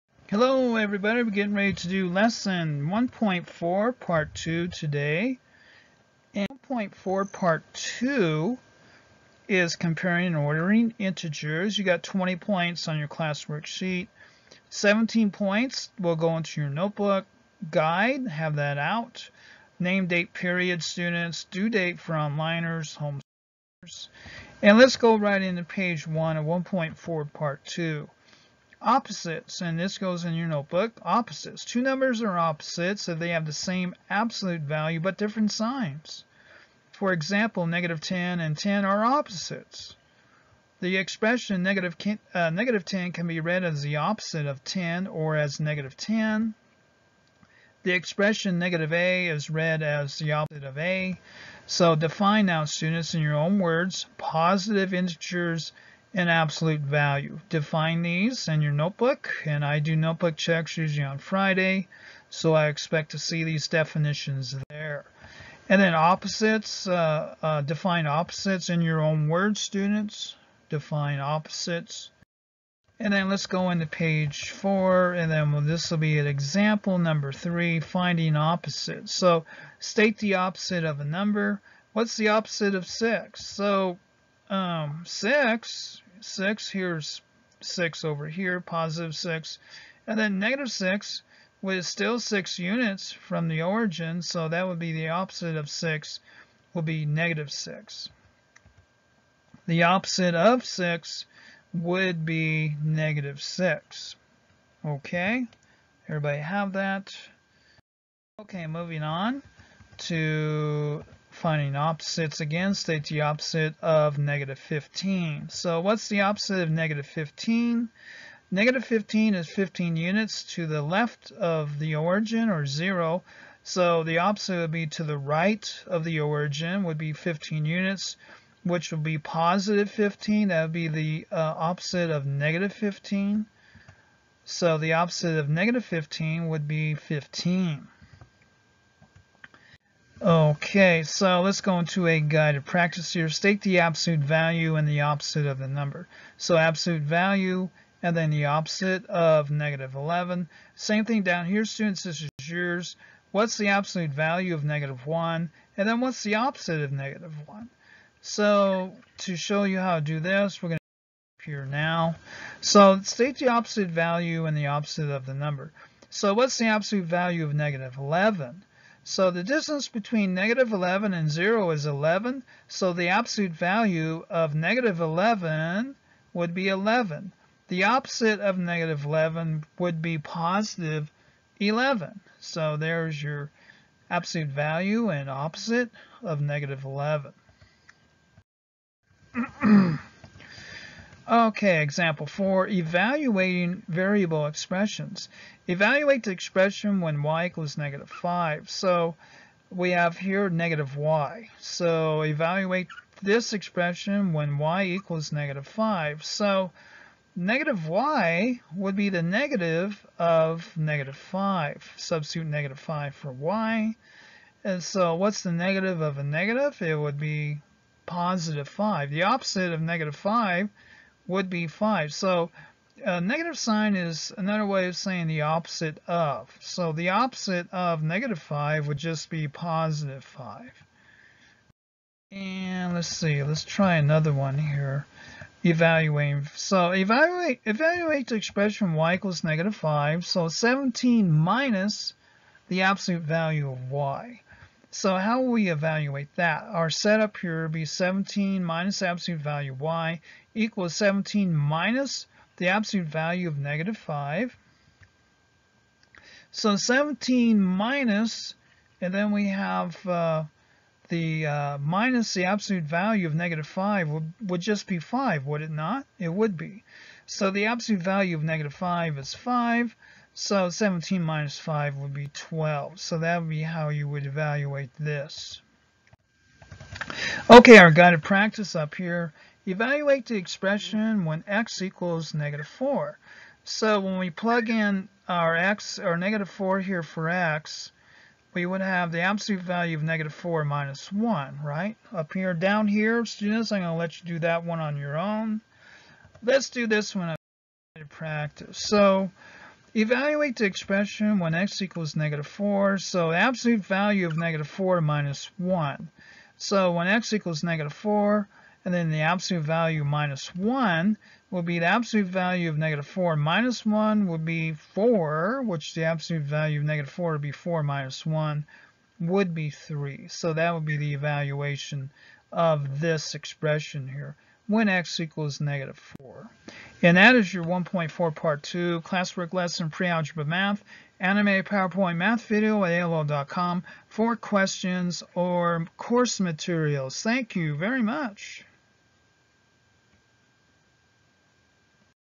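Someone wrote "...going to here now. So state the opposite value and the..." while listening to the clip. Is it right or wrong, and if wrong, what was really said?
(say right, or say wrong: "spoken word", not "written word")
right.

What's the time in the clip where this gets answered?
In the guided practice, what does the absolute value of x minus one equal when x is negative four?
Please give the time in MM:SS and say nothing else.
05:19.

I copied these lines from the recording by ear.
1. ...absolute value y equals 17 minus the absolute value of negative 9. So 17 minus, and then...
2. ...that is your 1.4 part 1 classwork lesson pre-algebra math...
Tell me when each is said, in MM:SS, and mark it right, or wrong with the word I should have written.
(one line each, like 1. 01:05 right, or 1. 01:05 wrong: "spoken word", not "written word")
1. 04:09 wrong: "5", not "9"
2. 05:27 wrong: "2", not "1".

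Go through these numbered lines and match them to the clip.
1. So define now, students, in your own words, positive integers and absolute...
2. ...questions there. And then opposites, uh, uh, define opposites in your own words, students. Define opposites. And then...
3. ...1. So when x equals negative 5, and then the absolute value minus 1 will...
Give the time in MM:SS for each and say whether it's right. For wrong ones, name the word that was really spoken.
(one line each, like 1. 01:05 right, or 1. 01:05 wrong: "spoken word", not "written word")
1. 00:51 right
2. 01:03 wrong: "definitions", not "questions"
3. 05:05 wrong: "4", not "5".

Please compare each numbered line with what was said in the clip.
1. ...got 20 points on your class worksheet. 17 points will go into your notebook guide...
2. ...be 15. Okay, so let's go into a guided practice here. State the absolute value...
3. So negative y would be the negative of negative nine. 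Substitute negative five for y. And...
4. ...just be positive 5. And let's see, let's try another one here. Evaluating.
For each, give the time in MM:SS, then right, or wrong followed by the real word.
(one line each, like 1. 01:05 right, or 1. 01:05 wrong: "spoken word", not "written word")
1. 00:11 right
2. 02:16 right
3. 03:26 wrong: "five", not "nine"
4. 03:48 right.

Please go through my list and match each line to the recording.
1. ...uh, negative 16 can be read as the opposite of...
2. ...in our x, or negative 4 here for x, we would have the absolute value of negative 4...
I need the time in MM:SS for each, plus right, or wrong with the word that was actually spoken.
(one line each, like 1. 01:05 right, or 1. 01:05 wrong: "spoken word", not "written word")
1. 00:42 wrong: "10", not "16"
2. 04:44 right.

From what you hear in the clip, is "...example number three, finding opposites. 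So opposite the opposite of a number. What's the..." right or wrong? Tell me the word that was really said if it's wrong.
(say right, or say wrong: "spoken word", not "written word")
wrong: "state", not "opposite".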